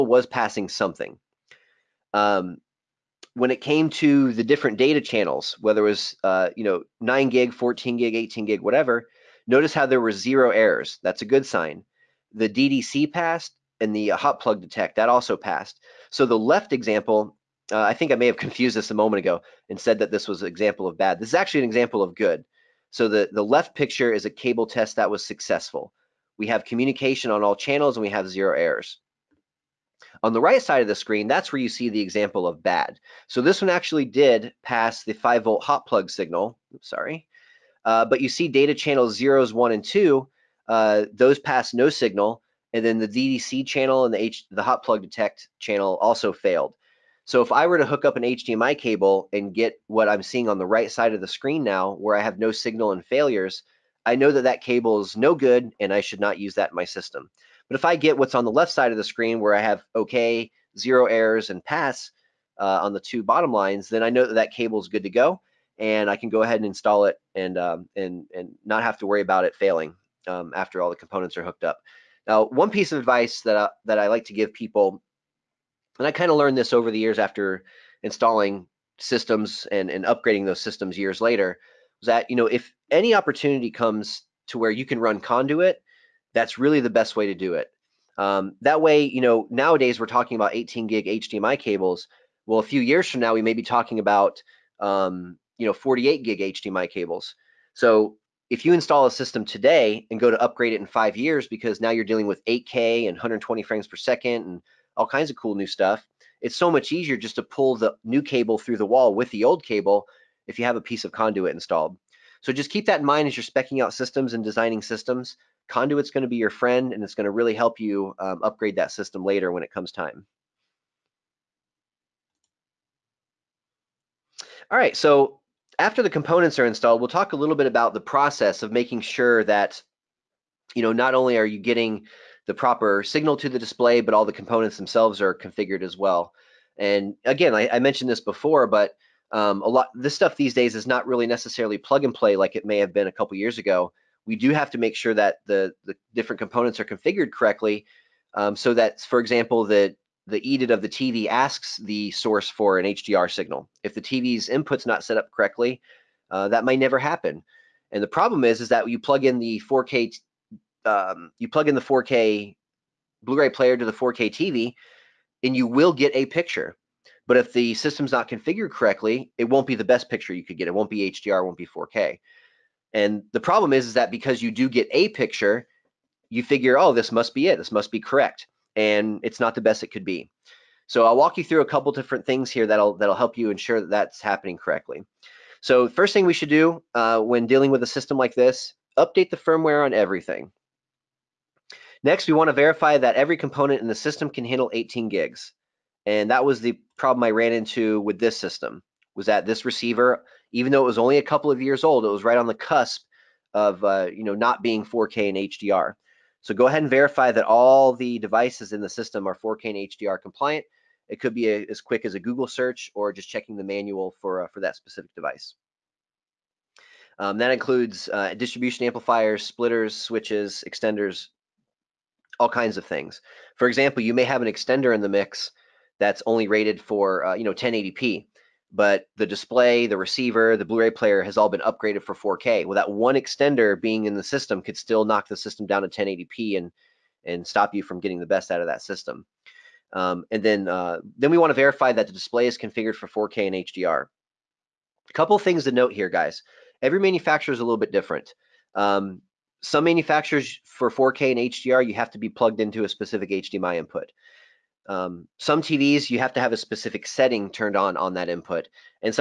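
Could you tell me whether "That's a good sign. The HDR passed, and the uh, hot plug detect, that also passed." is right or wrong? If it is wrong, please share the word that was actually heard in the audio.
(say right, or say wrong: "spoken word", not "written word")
wrong: "DDC", not "HDR".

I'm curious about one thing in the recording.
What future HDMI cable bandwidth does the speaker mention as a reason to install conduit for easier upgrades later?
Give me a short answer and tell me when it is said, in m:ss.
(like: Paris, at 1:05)
48 gig, at 1:35.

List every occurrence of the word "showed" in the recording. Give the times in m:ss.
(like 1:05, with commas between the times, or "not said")
not said.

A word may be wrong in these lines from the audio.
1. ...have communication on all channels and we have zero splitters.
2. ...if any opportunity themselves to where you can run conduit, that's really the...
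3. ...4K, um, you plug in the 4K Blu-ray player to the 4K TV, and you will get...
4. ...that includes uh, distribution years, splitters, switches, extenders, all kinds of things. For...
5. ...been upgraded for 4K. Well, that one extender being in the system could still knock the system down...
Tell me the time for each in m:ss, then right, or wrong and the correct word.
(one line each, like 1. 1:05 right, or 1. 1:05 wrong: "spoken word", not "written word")
1. 0:26 wrong: "errors", not "splitters"
2. 1:22 wrong: "comes", not "themselves"
3. 2:39 right
4. 3:37 wrong: "amplifiers", not "years"
5. 3:51 right.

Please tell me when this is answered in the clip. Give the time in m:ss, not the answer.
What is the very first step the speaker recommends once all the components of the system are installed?
3:08.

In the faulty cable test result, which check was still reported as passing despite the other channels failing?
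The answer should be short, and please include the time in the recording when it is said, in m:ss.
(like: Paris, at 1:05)
5 volt hot plug signal, at 0:35.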